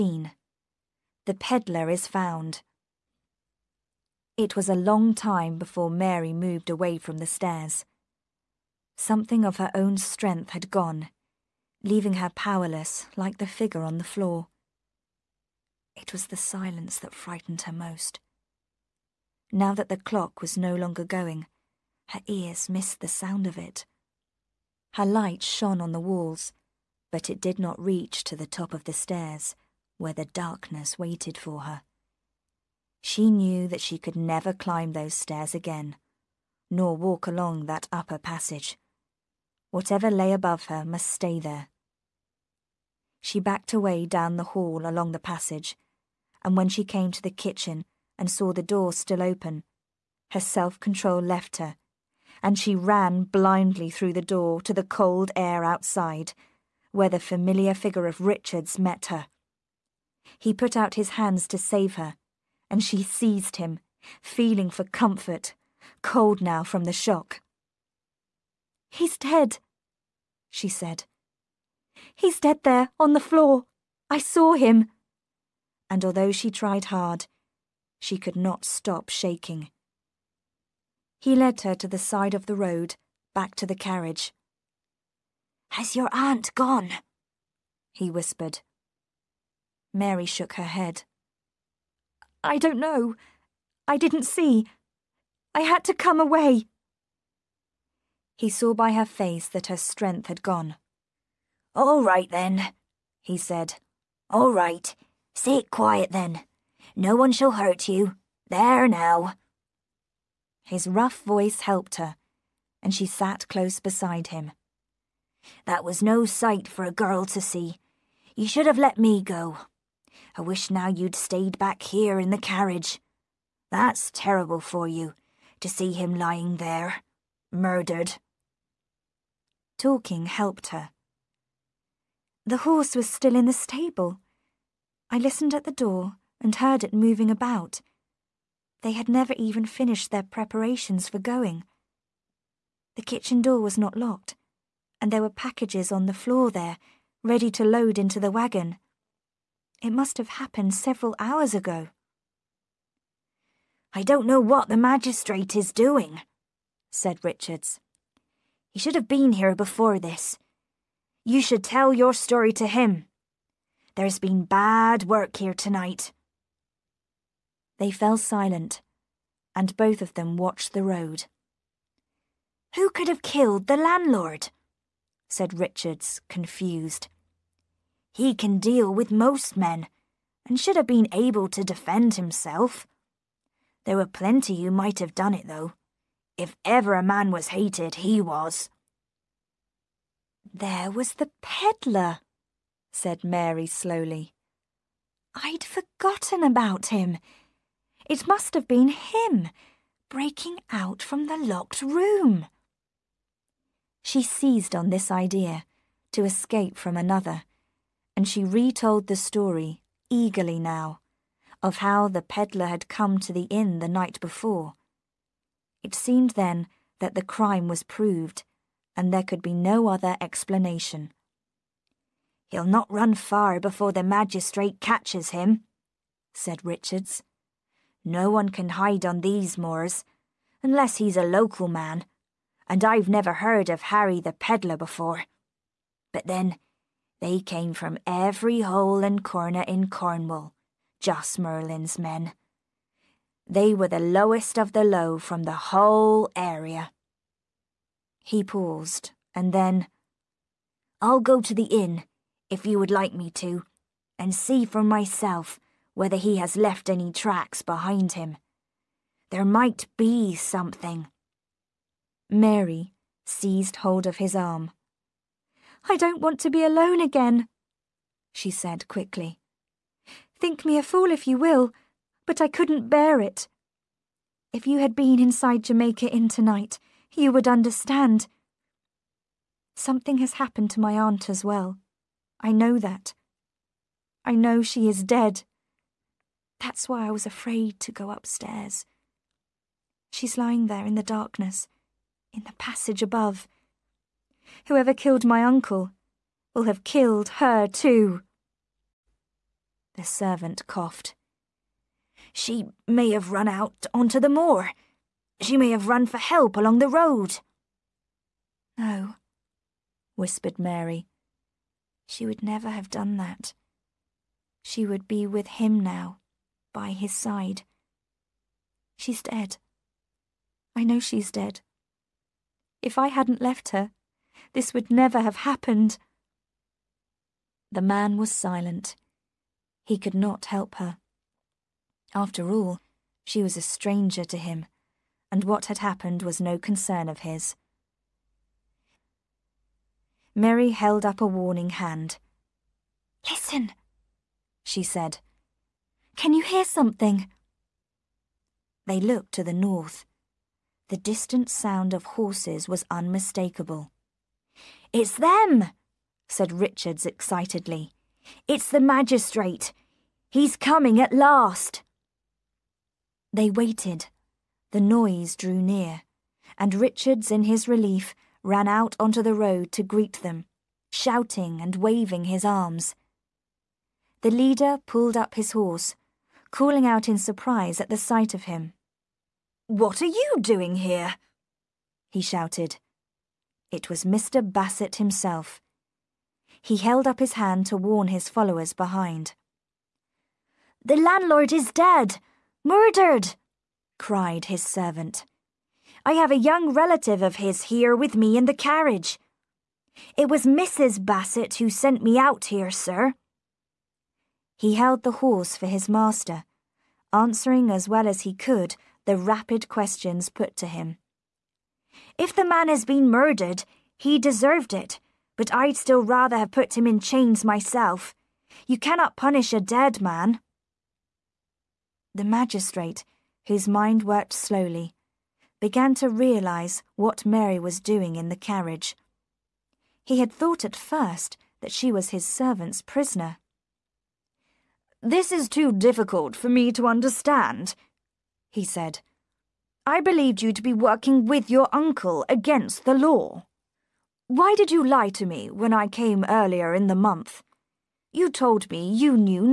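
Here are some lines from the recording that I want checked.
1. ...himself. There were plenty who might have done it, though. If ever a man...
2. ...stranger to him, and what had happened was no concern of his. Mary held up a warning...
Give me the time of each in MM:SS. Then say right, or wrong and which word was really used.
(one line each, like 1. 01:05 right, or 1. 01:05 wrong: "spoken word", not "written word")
1. 03:02 right
2. 05:33 right.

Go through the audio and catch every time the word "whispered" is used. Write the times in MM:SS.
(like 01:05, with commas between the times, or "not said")
01:28, 05:10.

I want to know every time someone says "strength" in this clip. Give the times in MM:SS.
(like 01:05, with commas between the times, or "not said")
00:09, 01:39.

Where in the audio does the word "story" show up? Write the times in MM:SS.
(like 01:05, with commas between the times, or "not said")
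02:42, 03:29.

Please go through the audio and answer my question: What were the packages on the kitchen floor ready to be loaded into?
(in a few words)
The wagon.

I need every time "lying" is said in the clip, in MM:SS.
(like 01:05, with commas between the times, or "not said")
02:06, 04:50.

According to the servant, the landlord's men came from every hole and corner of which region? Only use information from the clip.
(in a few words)
Cornwall.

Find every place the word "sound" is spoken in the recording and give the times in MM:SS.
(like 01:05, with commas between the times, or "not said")
00:23, 05:51.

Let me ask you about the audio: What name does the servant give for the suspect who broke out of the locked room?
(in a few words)
Harry the Peddler.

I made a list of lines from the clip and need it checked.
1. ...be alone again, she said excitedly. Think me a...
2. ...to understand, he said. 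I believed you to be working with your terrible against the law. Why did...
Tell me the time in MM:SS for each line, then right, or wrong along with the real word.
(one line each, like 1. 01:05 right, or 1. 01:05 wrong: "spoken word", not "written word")
1. 04:26 wrong: "quickly", not "excitedly"
2. 07:16 wrong: "uncle", not "terrible".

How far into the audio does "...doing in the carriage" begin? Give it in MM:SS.
07:07.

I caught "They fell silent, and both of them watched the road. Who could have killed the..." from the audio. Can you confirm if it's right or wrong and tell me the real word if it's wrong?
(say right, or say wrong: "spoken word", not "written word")
right.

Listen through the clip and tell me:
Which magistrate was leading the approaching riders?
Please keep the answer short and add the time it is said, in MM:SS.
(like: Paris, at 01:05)
Mr. Bassett, at 06:24.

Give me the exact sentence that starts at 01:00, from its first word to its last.
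He put out his hands to save her, and she seized him, feeling for comfort, cold now from the shock.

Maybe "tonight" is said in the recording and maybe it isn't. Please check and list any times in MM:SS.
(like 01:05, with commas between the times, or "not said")
02:45, 04:36.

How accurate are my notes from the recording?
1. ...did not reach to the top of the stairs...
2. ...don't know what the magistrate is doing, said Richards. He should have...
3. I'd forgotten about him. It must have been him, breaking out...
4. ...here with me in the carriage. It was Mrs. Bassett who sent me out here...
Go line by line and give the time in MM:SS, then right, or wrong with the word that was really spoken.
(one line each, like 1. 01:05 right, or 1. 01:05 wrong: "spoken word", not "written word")
1. 00:27 right
2. 02:34 right
3. 03:15 right
4. 06:37 right.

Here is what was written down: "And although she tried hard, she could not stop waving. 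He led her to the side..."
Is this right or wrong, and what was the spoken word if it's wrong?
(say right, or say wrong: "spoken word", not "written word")
wrong: "shaking", not "waving".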